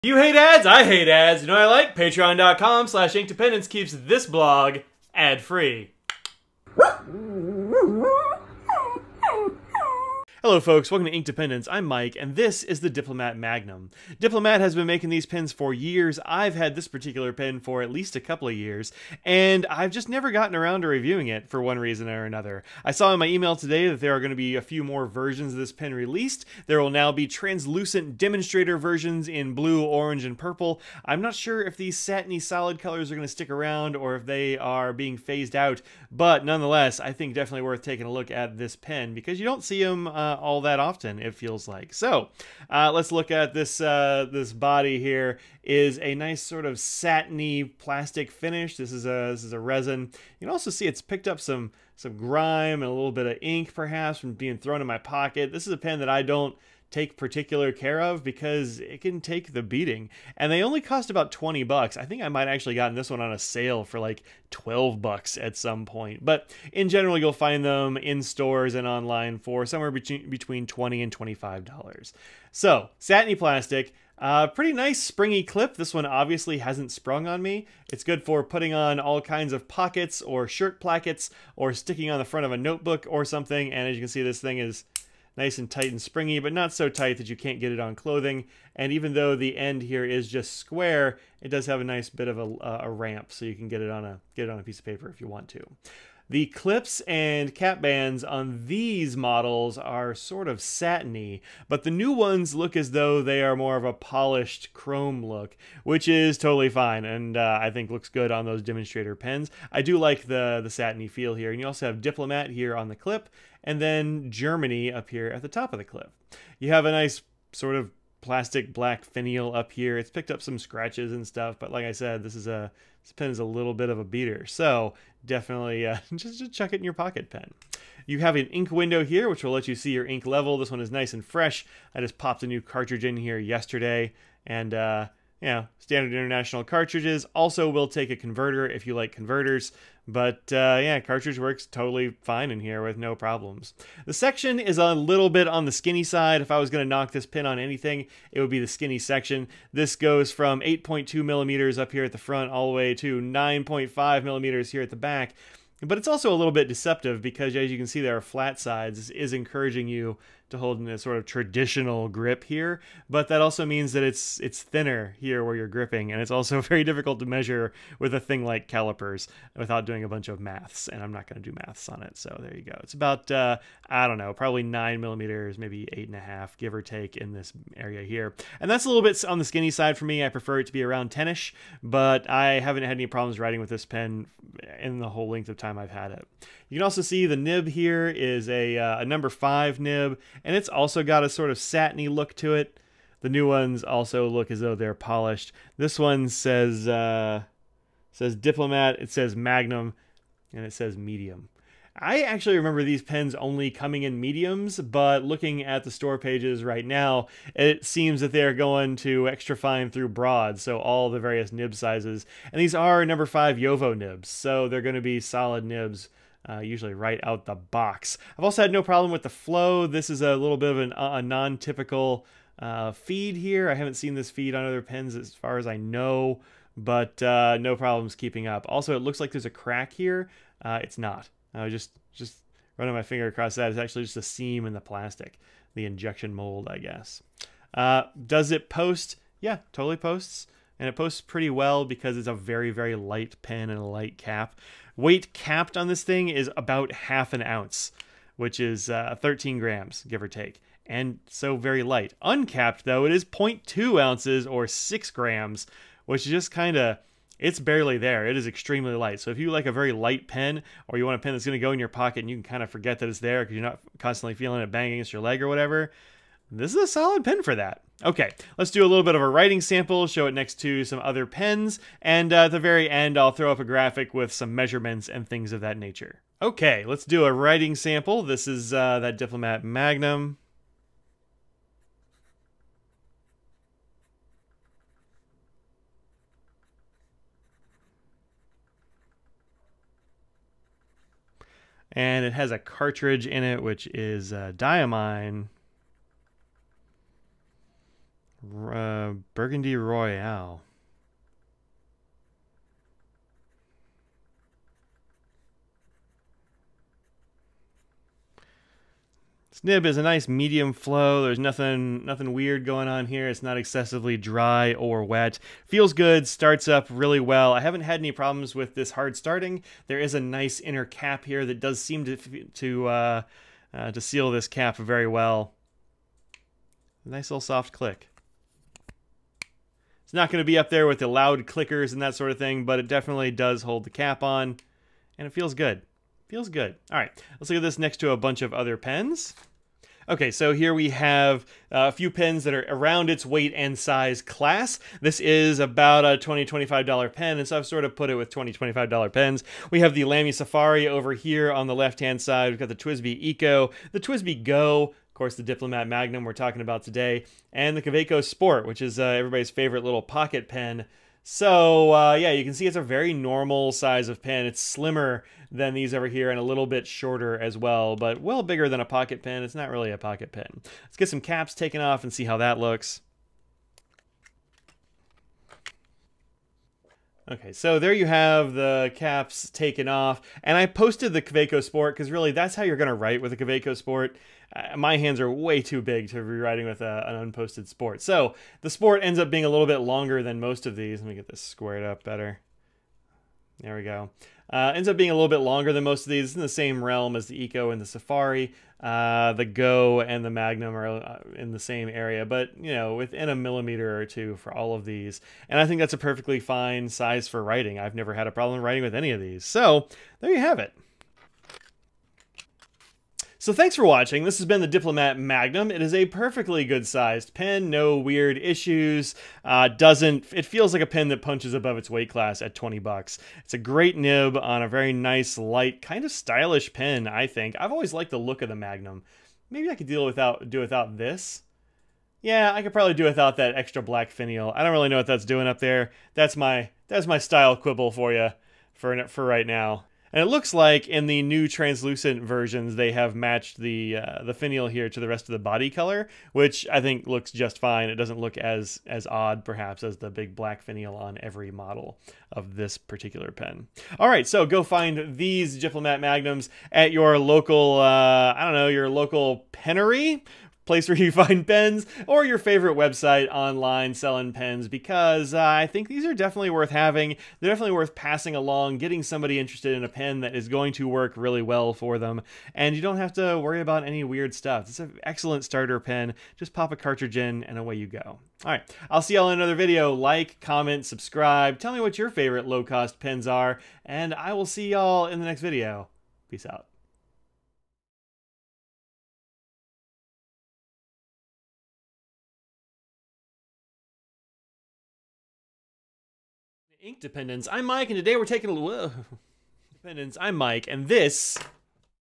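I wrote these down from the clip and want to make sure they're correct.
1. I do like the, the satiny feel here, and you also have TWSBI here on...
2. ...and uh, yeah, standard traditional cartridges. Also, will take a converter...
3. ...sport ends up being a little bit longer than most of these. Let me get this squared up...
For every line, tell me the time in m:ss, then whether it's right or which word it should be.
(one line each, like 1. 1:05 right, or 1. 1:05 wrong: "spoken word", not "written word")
1. 1:49 wrong: "Diplomat", not "TWSBI"
2. 2:14 wrong: "international", not "traditional"
3. 6:28 right.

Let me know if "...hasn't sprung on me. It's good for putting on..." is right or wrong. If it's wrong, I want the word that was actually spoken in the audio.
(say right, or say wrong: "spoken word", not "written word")
right.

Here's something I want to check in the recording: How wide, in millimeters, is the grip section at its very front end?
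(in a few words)
8.2 millimeters.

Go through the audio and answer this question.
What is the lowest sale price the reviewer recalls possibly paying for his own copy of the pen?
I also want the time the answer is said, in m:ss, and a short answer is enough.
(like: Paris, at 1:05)
$12, at 1:04.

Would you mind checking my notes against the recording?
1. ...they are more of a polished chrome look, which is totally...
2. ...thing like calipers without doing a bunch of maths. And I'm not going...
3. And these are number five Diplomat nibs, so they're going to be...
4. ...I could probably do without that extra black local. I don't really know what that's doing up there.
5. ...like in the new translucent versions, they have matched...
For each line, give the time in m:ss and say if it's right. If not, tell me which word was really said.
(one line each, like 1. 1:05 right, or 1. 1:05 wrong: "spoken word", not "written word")
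1. 1:43 right
2. 2:48 right
3. 3:32 wrong: "JoWo", not "Diplomat"
4. 7:12 wrong: "finial", not "local"
5. 7:20 right.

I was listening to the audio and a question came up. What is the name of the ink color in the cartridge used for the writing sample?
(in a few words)
Burgundy Royale.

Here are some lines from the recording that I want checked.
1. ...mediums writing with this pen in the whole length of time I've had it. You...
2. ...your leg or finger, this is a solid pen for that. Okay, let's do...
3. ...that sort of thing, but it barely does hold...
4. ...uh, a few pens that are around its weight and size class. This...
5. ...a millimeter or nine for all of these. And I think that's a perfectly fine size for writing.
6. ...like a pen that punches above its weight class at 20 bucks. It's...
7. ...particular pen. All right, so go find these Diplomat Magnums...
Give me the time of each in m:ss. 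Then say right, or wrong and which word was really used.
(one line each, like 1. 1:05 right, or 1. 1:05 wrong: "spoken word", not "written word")
1. 3:03 wrong: "problems", not "mediums"
2. 4:25 wrong: "whatever", not "finger"
3. 5:32 wrong: "definitely", not "barely"
4. 5:41 right
5. 6:43 wrong: "two", not "nine"
6. 7:00 right
7. 7:32 right.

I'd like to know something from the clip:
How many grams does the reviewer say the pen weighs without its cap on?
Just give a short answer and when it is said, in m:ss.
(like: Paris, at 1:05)
6 grams, at 4:14.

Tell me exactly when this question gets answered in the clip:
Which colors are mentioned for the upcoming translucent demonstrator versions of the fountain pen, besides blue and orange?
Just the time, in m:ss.
0:30.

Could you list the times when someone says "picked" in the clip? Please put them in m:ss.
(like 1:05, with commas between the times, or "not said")
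0:51, 2:00.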